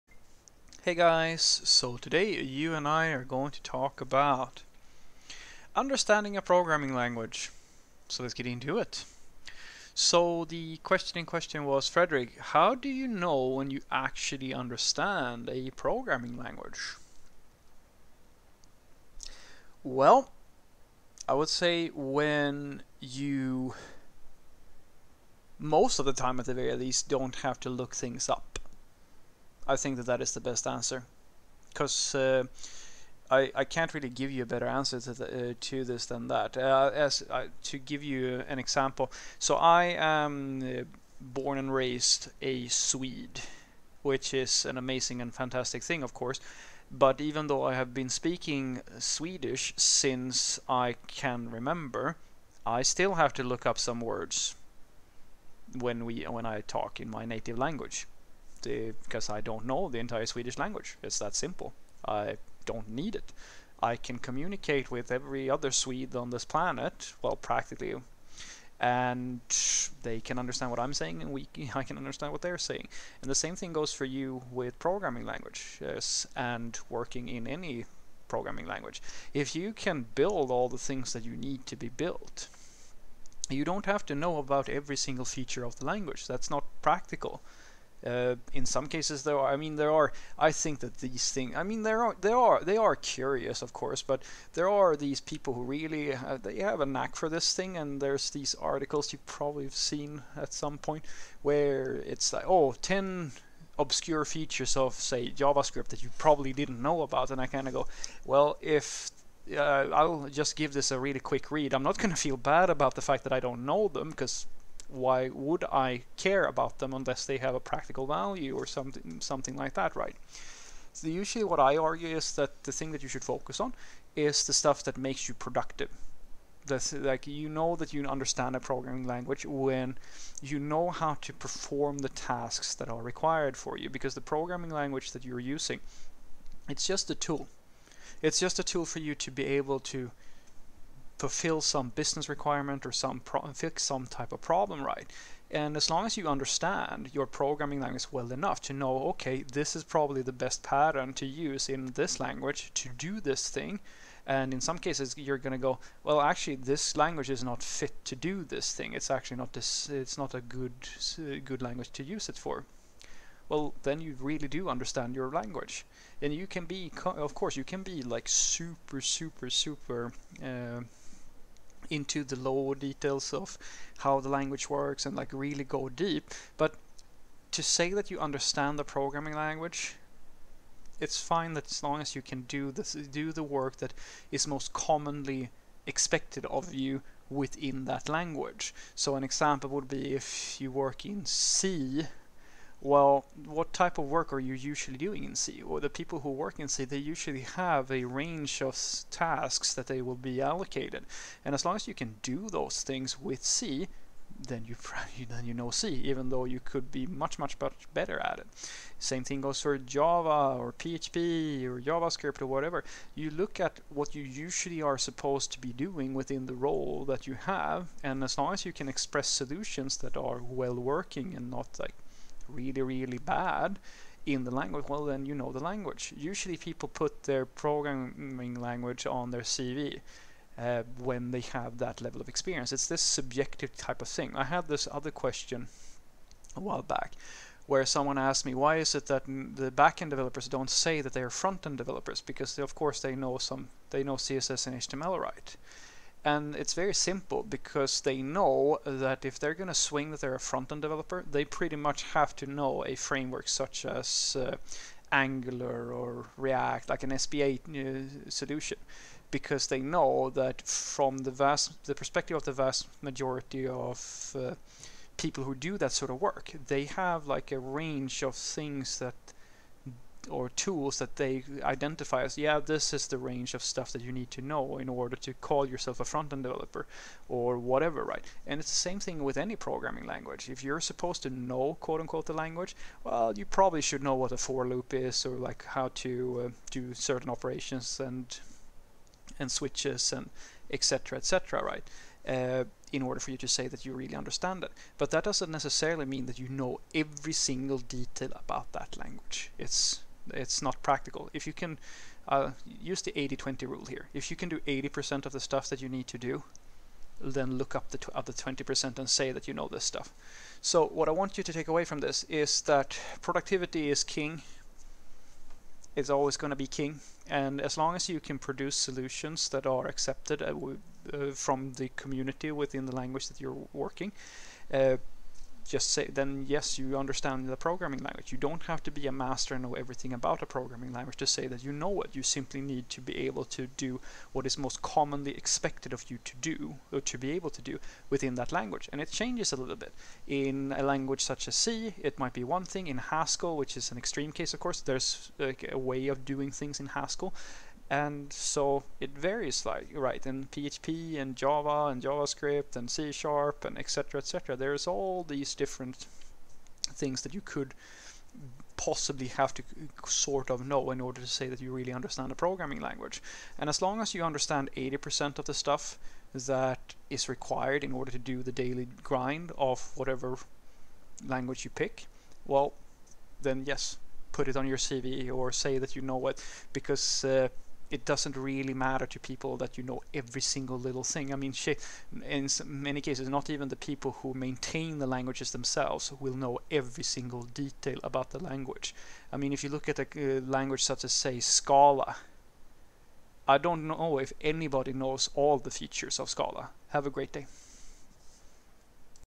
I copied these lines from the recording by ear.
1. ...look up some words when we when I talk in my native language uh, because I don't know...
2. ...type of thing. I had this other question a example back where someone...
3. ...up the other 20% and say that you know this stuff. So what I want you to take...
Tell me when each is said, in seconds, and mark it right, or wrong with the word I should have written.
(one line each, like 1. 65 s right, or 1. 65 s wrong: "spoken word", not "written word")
1. 53 s right
2. 233 s wrong: "while", not "example"
3. 307 s right.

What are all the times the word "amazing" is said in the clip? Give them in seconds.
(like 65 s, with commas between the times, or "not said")
44 s.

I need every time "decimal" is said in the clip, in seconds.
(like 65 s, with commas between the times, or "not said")
not said.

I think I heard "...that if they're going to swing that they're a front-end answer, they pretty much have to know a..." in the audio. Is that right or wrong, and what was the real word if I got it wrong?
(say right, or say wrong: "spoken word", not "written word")
wrong: "developer", not "answer".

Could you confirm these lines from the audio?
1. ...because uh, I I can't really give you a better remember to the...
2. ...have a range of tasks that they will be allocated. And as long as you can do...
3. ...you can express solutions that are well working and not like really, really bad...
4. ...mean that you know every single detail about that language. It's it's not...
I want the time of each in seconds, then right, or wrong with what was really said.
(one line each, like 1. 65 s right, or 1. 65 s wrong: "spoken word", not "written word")
1. 31 s wrong: "answer", not "remember"
2. 197 s right
3. 218 s right
4. 296 s right.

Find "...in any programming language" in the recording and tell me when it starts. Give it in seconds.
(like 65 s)
77 s.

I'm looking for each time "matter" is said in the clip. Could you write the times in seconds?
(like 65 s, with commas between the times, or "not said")
378 s.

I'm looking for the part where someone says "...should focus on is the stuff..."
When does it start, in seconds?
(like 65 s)
123 s.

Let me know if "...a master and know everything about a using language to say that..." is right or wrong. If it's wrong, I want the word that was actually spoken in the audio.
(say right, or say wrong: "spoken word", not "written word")
wrong: "programming", not "using".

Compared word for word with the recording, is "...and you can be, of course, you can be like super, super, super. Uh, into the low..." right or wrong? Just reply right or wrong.
right.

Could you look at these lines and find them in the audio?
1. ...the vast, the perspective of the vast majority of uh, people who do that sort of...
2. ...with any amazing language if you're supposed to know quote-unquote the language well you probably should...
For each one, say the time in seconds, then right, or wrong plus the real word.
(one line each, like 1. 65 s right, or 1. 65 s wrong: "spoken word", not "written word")
1. 261 s right
2. 279 s wrong: "programming", not "amazing".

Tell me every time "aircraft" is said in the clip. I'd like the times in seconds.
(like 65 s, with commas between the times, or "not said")
not said.